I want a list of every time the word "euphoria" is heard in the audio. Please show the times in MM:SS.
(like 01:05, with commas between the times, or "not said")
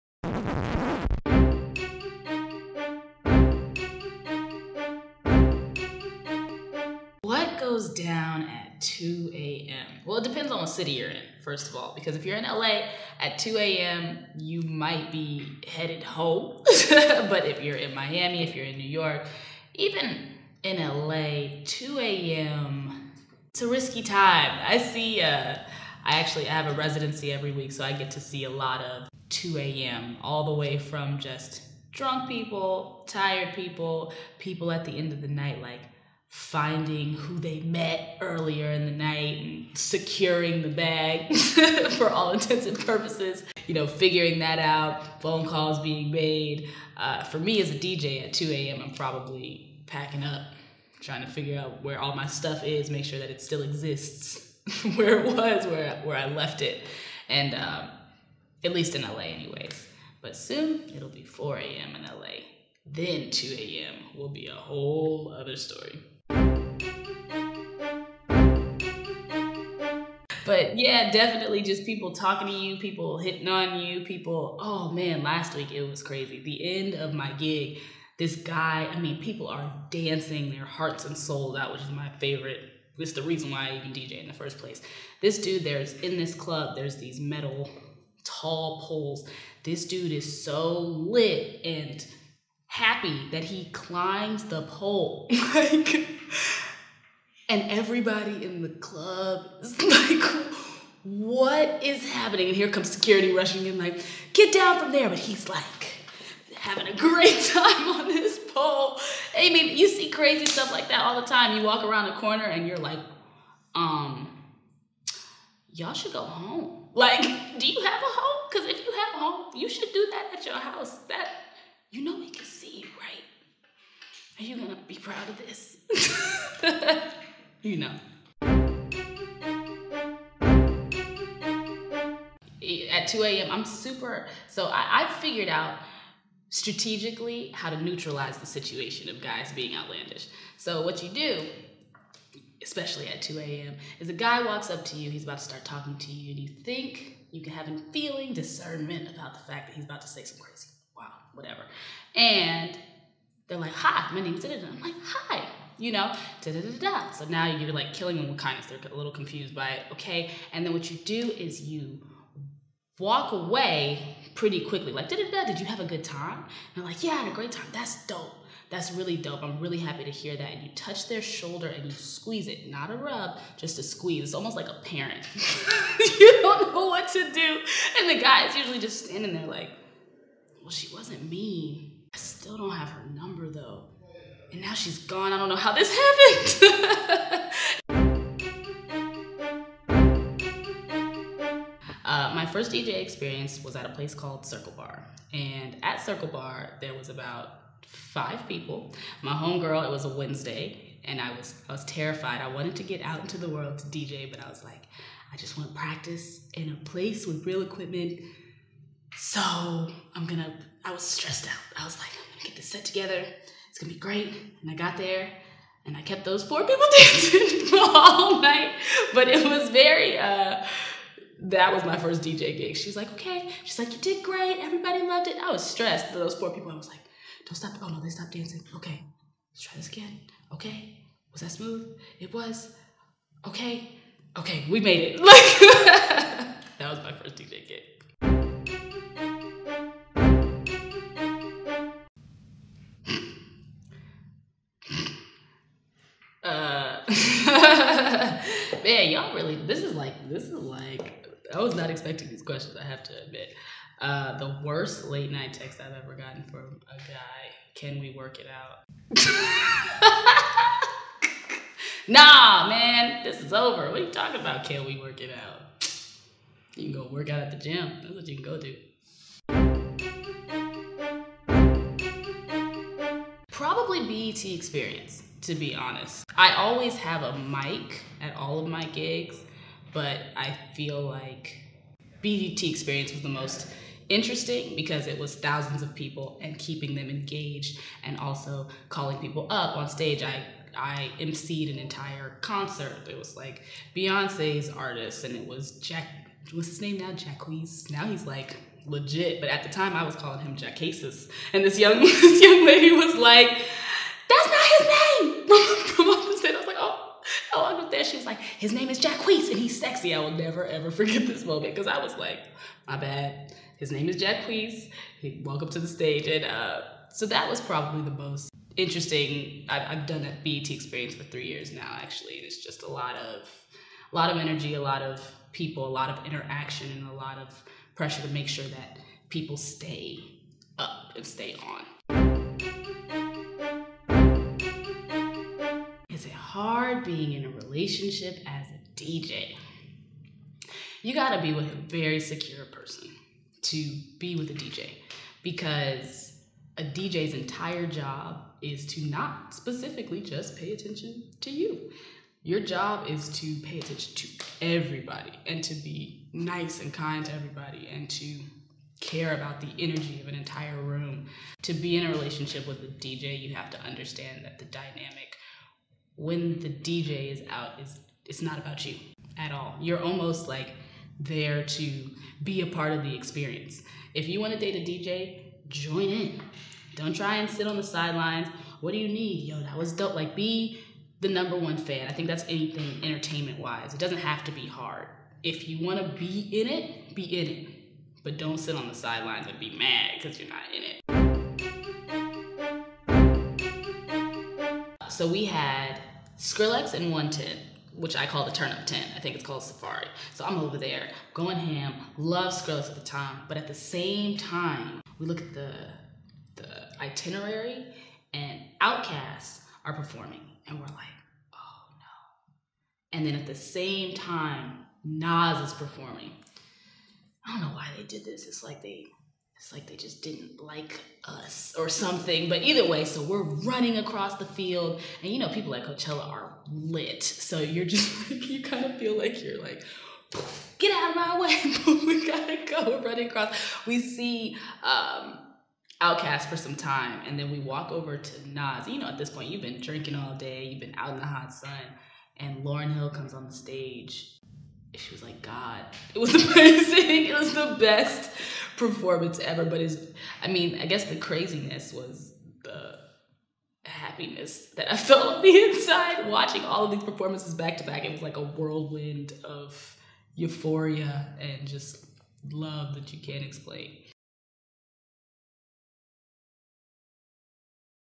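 07:40.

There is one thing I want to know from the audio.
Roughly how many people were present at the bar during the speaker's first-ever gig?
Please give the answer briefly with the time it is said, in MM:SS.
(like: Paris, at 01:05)
5, at 03:17.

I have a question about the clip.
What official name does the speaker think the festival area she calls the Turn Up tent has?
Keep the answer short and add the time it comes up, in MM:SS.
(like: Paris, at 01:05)
Sahara, at 06:39.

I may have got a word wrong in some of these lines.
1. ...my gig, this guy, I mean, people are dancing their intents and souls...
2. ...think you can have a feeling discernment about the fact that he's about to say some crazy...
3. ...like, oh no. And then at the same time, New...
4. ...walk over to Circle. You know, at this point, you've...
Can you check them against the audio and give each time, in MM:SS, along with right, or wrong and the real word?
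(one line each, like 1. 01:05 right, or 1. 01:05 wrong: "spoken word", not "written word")
1. 01:17 wrong: "hearts", not "intents"
2. 02:26 right
3. 06:50 wrong: "Nas", not "New"
4. 07:17 wrong: "Nas", not "Circle".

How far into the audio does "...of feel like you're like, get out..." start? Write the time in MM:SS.
07:08.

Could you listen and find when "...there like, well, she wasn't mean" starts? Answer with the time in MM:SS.
02:59.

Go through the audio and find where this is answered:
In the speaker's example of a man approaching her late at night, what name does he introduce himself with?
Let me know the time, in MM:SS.
02:34.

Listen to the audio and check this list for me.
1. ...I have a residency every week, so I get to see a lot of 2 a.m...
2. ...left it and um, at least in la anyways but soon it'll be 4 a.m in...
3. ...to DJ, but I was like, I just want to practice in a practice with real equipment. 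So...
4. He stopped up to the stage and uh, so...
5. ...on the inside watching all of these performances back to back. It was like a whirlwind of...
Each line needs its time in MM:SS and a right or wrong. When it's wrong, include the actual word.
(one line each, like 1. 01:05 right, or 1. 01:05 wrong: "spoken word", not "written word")
1. 00:26 right
2. 00:56 right
3. 03:23 wrong: "place", not "practice"
4. 05:15 wrong: "walked", not "stopped"
5. 07:35 right.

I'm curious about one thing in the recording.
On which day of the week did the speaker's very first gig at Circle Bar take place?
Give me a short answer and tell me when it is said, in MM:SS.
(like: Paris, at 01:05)
Wednesday, at 03:20.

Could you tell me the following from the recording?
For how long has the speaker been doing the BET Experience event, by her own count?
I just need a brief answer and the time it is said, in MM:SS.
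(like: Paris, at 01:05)
3 years, at 05:21.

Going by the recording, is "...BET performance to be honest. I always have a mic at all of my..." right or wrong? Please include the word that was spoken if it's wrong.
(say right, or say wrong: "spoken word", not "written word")
wrong: "experience", not "performance".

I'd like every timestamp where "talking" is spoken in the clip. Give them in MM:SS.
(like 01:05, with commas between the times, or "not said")
01:12, 02:25, 04:24.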